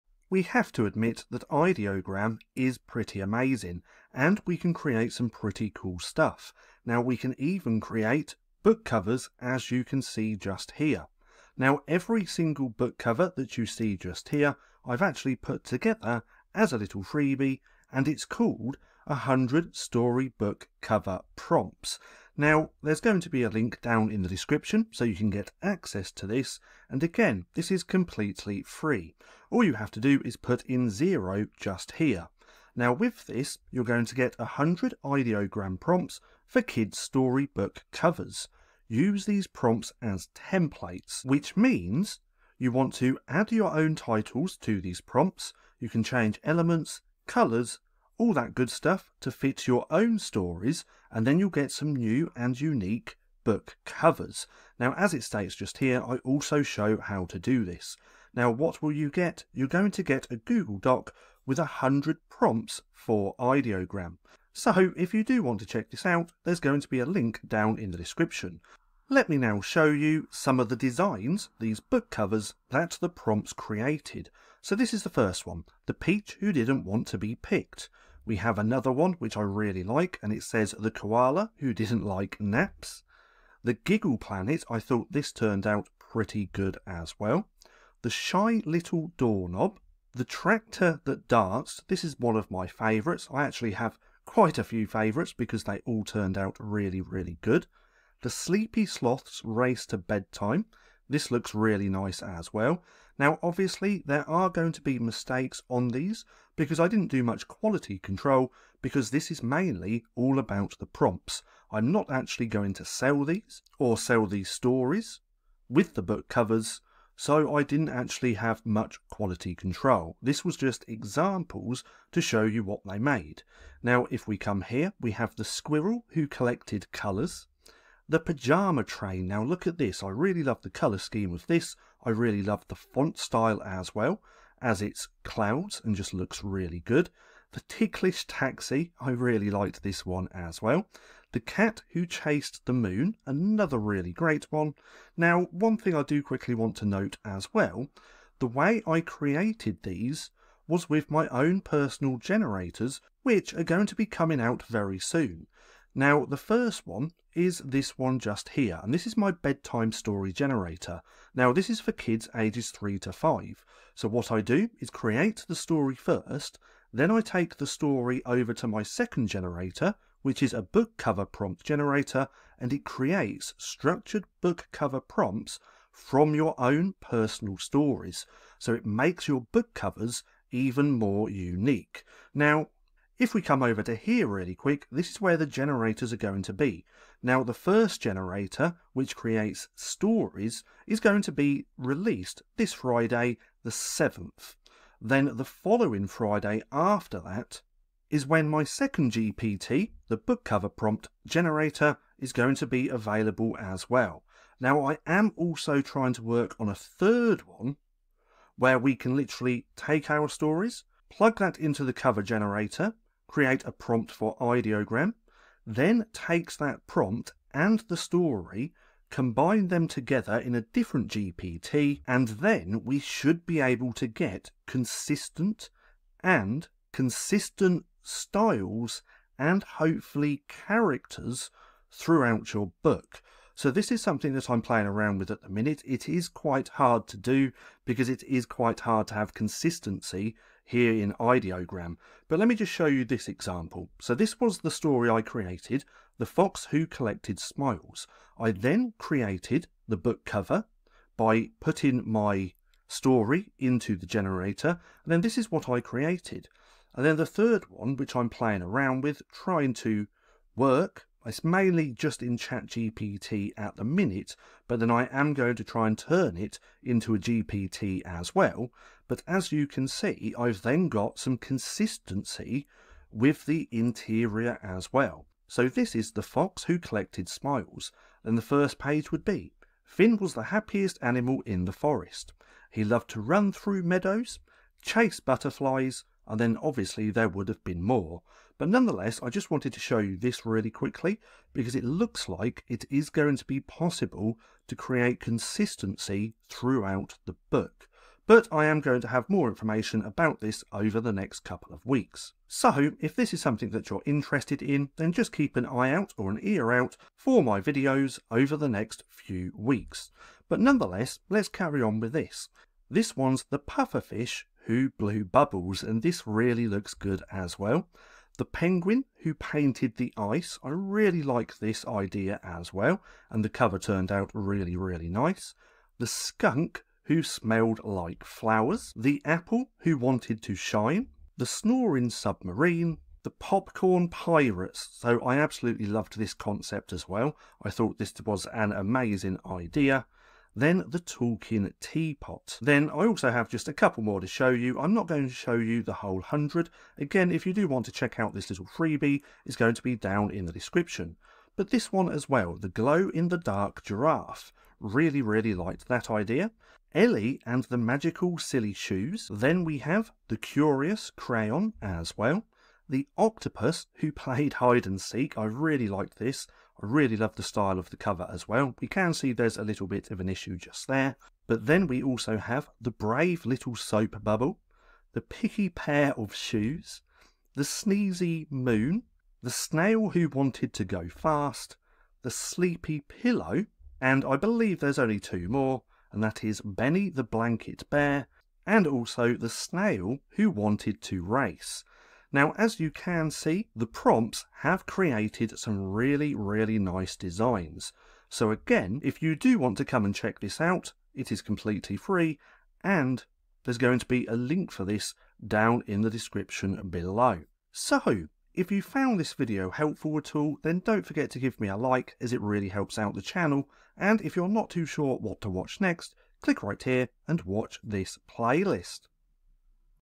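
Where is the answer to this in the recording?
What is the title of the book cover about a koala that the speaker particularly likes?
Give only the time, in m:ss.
1:20.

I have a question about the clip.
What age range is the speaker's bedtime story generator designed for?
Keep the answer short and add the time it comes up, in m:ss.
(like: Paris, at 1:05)
3 to 5, at 2:42.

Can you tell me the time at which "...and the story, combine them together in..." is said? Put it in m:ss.
3:37.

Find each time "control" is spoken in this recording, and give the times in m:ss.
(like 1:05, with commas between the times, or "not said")
1:47, 1:59.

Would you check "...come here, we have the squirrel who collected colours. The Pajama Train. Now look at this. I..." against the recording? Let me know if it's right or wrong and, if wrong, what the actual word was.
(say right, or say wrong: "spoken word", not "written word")
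right.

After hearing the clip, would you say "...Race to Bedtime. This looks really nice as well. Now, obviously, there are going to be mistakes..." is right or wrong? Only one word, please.
right.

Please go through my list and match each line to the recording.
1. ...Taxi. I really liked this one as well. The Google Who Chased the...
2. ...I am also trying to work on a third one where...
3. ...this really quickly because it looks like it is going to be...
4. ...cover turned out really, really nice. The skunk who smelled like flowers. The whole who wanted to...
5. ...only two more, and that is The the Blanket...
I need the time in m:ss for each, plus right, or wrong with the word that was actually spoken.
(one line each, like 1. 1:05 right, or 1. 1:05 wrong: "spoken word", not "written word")
1. 2:18 wrong: "Cat", not "Google"
2. 3:24 right
3. 4:50 right
4. 5:23 wrong: "apple", not "whole"
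5. 6:24 wrong: "Benny", not "The".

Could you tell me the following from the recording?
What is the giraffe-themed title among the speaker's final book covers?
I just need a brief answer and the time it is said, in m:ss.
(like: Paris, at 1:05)
The Glow in the Dark Giraffe, at 5:52.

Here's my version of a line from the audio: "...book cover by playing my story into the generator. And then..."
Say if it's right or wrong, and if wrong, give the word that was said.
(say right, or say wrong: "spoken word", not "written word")
wrong: "putting", not "playing".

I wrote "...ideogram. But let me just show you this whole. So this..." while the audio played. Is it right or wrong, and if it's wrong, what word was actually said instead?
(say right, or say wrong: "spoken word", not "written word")
wrong: "example", not "whole".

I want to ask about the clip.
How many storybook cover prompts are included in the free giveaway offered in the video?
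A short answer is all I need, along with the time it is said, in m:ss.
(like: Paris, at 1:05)
100, at 0:19.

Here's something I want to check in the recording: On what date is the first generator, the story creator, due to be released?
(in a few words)
Friday the 7th.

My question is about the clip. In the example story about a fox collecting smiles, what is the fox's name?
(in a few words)
Finn.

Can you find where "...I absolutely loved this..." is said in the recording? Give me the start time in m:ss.
5:35.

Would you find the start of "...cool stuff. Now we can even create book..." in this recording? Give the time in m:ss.
0:05.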